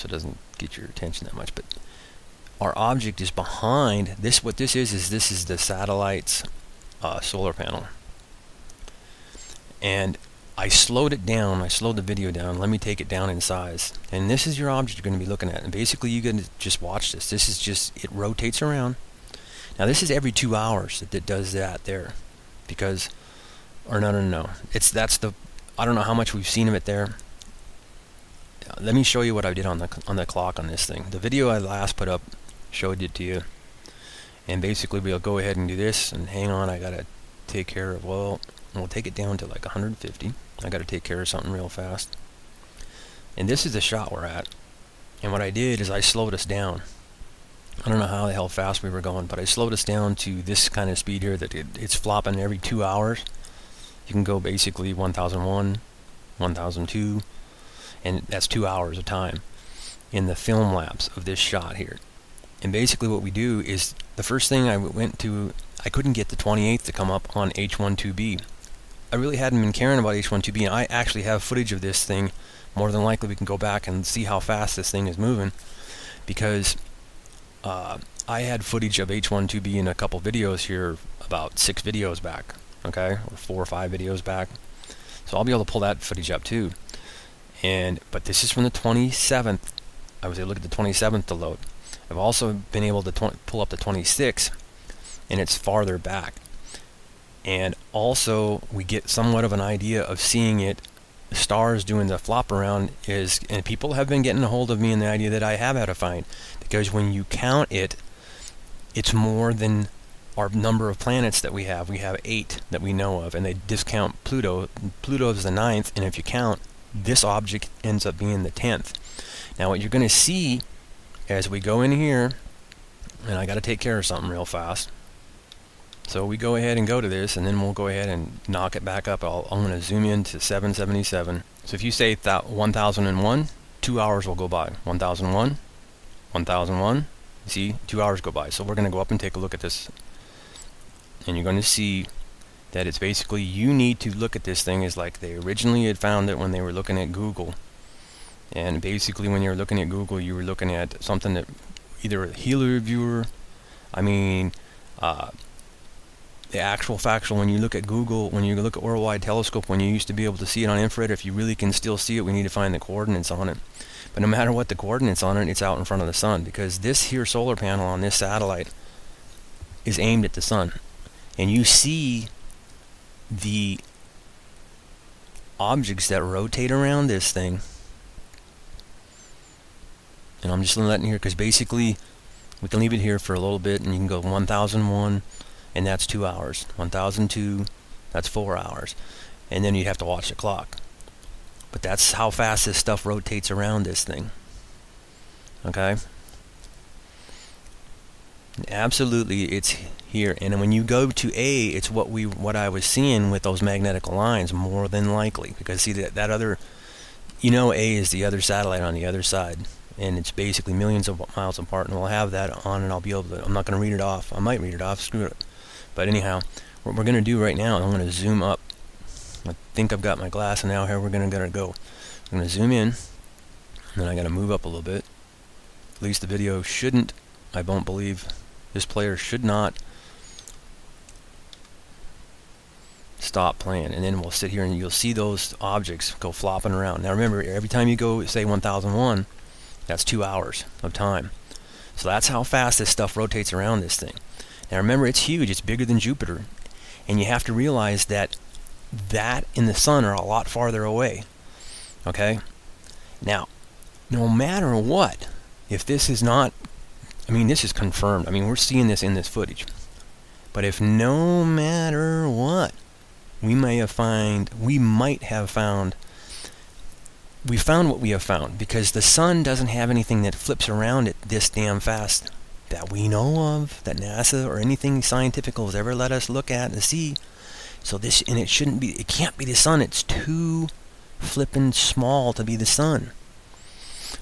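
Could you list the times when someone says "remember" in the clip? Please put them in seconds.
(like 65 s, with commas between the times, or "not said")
237 s, 244 s.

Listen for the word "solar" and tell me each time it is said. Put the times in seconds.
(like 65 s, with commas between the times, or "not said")
7 s, 167 s.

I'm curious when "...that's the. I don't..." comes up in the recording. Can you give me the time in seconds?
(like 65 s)
24 s.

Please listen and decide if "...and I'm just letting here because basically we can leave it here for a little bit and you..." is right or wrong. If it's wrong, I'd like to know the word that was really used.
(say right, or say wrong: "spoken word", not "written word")
right.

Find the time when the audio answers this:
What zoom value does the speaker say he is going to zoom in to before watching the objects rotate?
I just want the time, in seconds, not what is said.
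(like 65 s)
130 s.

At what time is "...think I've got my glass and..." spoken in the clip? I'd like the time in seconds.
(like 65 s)
219 s.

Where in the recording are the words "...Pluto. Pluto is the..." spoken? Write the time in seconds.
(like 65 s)
114 s.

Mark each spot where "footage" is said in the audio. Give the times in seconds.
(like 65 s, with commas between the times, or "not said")
71 s, 78 s, 86 s, 259 s.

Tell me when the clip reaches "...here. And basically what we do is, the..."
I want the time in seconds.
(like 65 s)
61 s.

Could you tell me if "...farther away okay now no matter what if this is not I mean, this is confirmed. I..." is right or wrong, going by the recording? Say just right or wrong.
right.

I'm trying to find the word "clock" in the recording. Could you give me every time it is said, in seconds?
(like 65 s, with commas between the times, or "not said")
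30 s, 190 s.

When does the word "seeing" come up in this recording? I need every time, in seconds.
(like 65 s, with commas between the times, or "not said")
100 s, 202 s, 258 s.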